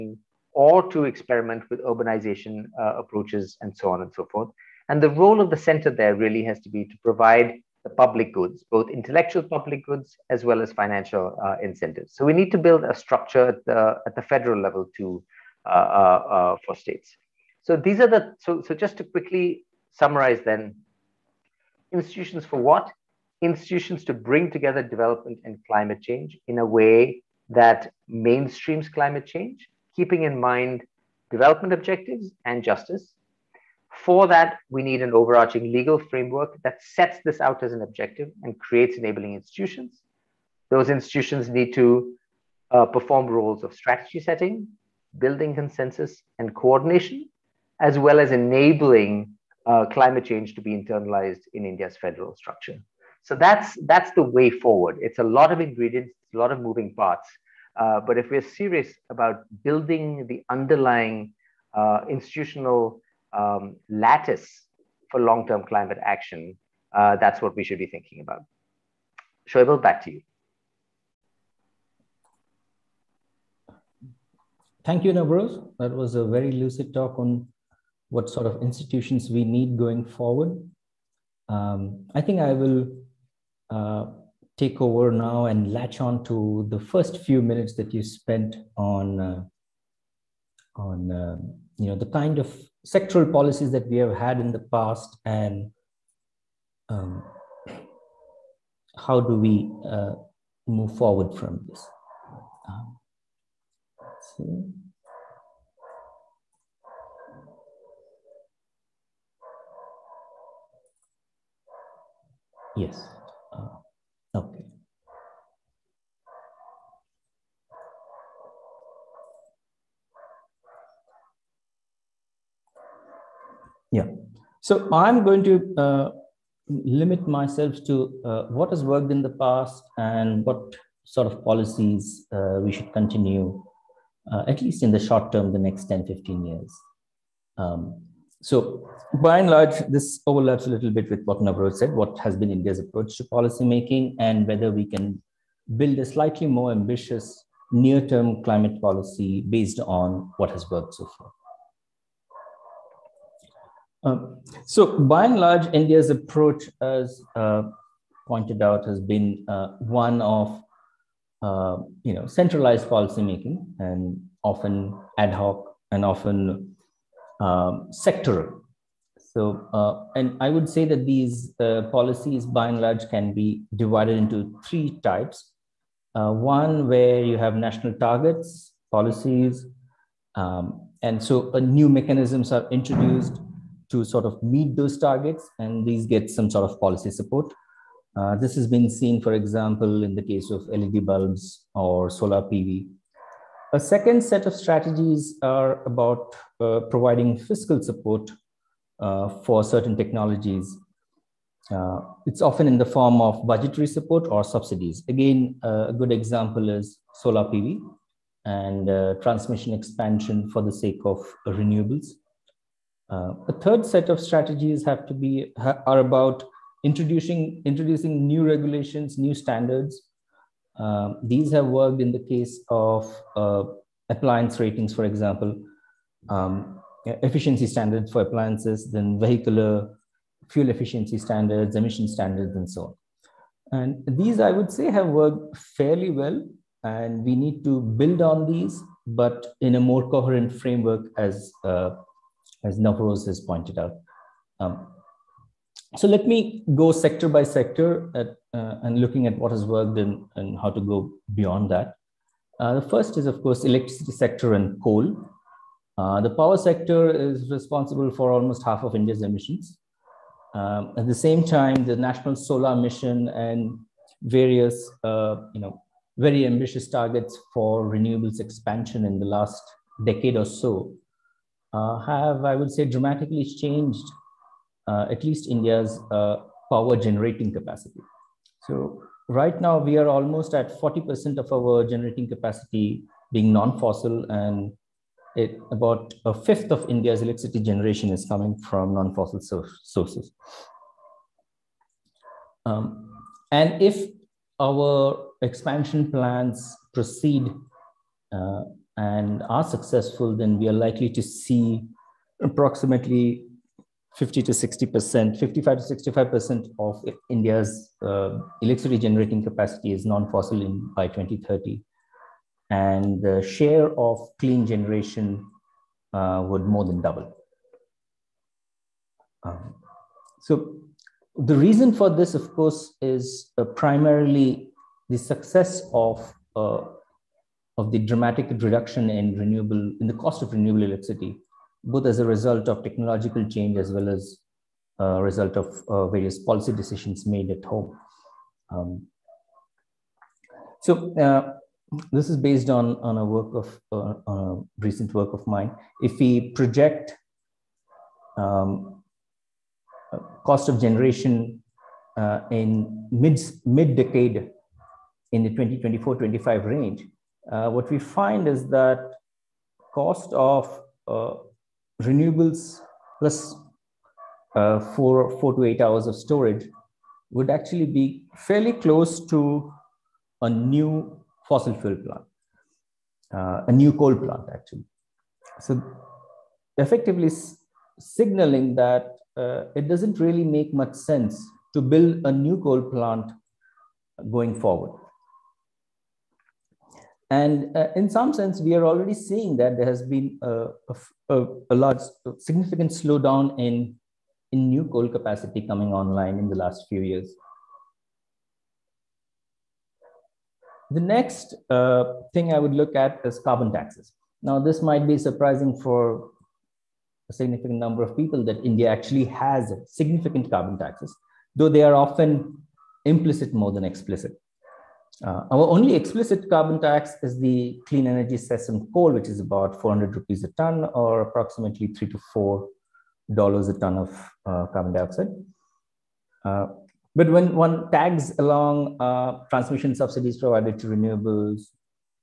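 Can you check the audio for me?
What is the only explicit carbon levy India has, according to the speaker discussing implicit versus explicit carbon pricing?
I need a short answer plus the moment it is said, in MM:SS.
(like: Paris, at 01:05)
clean energy cess, at 06:57.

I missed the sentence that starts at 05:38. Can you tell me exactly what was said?
Um, so uh, this is based on on a work of uh, a recent work of mine.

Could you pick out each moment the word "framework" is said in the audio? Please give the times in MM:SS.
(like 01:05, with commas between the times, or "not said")
00:35, 04:00.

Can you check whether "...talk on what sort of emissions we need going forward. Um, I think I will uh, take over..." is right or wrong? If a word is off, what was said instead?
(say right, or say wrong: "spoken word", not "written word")
wrong: "institutions", not "emissions".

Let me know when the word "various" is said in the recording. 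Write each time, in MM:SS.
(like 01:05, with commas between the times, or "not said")
04:24, 05:36.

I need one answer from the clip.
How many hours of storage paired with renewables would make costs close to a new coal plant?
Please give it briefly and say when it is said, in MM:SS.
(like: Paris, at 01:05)
4 to 8 hours, at 06:05.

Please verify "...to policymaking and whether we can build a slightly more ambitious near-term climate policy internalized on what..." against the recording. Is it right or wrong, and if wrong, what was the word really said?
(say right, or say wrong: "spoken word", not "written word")
wrong: "based", not "internalized".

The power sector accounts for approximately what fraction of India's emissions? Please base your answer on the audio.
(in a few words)
almost half.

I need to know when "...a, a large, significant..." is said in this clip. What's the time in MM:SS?
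06:31.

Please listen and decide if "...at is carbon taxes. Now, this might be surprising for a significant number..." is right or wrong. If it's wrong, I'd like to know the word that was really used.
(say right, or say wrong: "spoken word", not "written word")
right.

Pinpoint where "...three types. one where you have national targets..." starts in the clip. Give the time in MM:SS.
02:54.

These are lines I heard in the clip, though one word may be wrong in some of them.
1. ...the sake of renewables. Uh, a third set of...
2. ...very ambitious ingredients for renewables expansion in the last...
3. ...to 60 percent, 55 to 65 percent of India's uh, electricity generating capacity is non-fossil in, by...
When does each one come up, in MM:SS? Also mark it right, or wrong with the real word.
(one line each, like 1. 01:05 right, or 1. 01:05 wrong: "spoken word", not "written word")
1. 03:30 right
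2. 04:26 wrong: "targets", not "ingredients"
3. 05:04 right.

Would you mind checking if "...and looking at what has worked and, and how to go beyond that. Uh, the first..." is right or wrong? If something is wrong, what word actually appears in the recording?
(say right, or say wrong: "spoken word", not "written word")
right.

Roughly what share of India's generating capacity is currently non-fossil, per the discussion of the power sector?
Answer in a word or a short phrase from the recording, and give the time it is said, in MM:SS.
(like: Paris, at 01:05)
40%, at 04:40.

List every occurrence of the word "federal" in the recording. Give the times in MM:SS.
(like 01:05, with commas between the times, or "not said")
00:14, 00:51.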